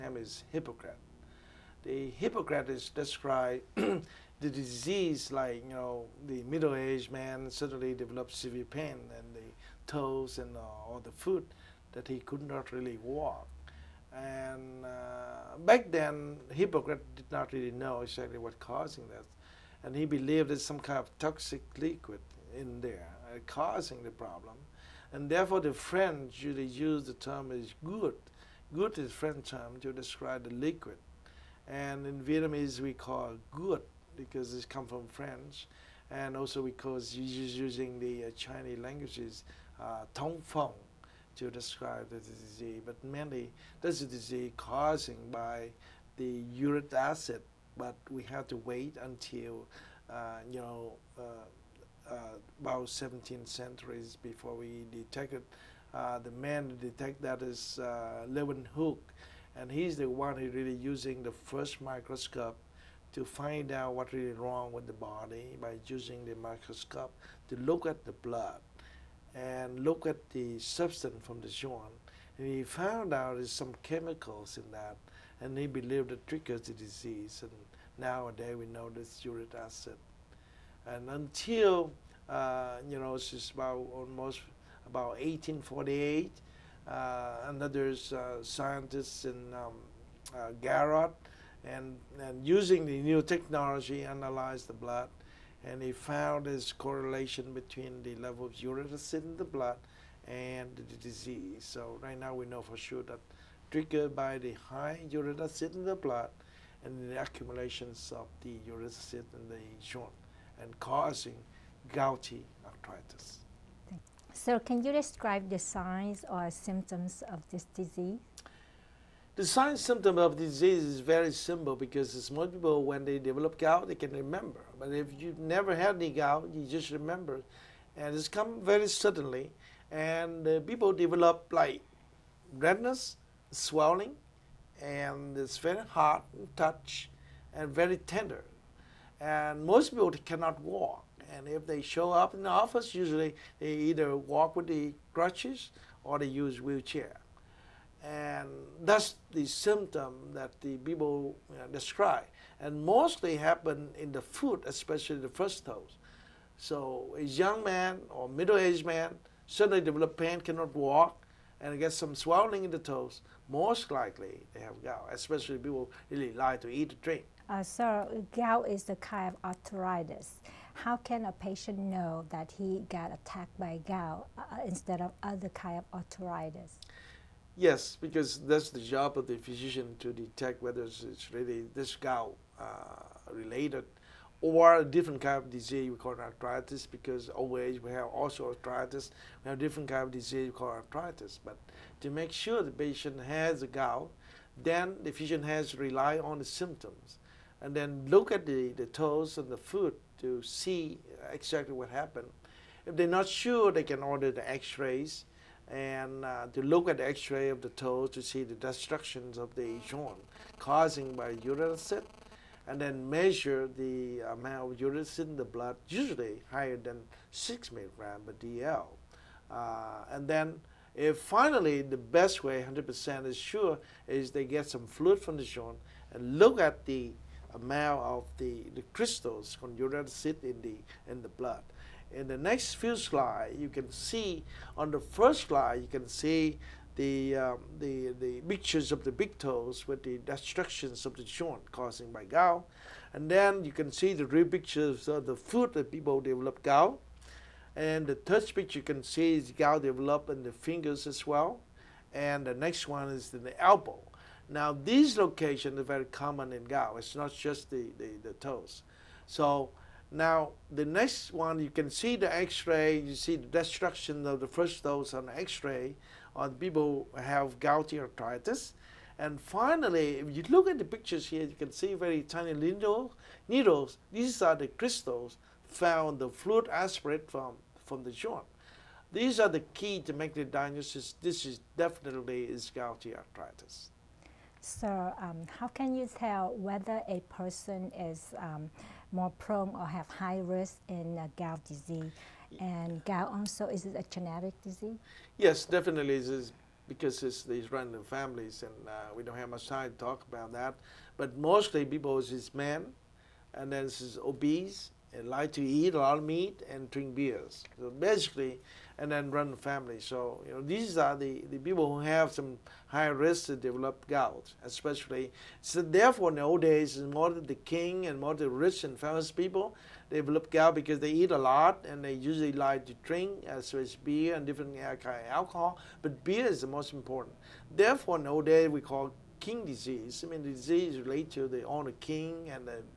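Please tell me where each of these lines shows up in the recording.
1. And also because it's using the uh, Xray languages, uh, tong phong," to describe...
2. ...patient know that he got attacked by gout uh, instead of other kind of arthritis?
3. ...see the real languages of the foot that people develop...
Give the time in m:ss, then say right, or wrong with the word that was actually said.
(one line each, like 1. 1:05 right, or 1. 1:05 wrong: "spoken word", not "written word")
1. 0:36 wrong: "Chinese", not "Xray"
2. 2:51 right
3. 4:03 wrong: "pictures", not "languages".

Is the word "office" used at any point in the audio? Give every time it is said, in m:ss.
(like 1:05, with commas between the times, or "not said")
2:22.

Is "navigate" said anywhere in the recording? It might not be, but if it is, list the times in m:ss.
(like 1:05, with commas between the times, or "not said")
not said.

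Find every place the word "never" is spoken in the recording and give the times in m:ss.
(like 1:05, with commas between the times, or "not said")
2:05.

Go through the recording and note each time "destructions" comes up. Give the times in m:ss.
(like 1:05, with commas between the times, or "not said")
3:28, 4:00, 4:23.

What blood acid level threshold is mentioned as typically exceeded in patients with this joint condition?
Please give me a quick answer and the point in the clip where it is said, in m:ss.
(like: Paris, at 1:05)
6 milligrams per dL, at 3:37.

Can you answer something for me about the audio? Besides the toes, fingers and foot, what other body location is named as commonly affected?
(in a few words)
elbow.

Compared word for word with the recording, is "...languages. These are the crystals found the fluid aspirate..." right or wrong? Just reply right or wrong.
wrong.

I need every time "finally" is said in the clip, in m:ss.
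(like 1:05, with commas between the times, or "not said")
3:41, 4:29.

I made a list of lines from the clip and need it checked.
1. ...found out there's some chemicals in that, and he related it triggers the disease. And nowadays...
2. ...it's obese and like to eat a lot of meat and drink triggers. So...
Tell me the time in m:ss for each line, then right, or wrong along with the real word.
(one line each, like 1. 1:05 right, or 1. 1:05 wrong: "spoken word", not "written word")
1. 1:12 wrong: "believed", not "related"
2. 5:03 wrong: "beers", not "triggers".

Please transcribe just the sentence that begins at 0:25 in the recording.
And therefore, the French usually use the term is good.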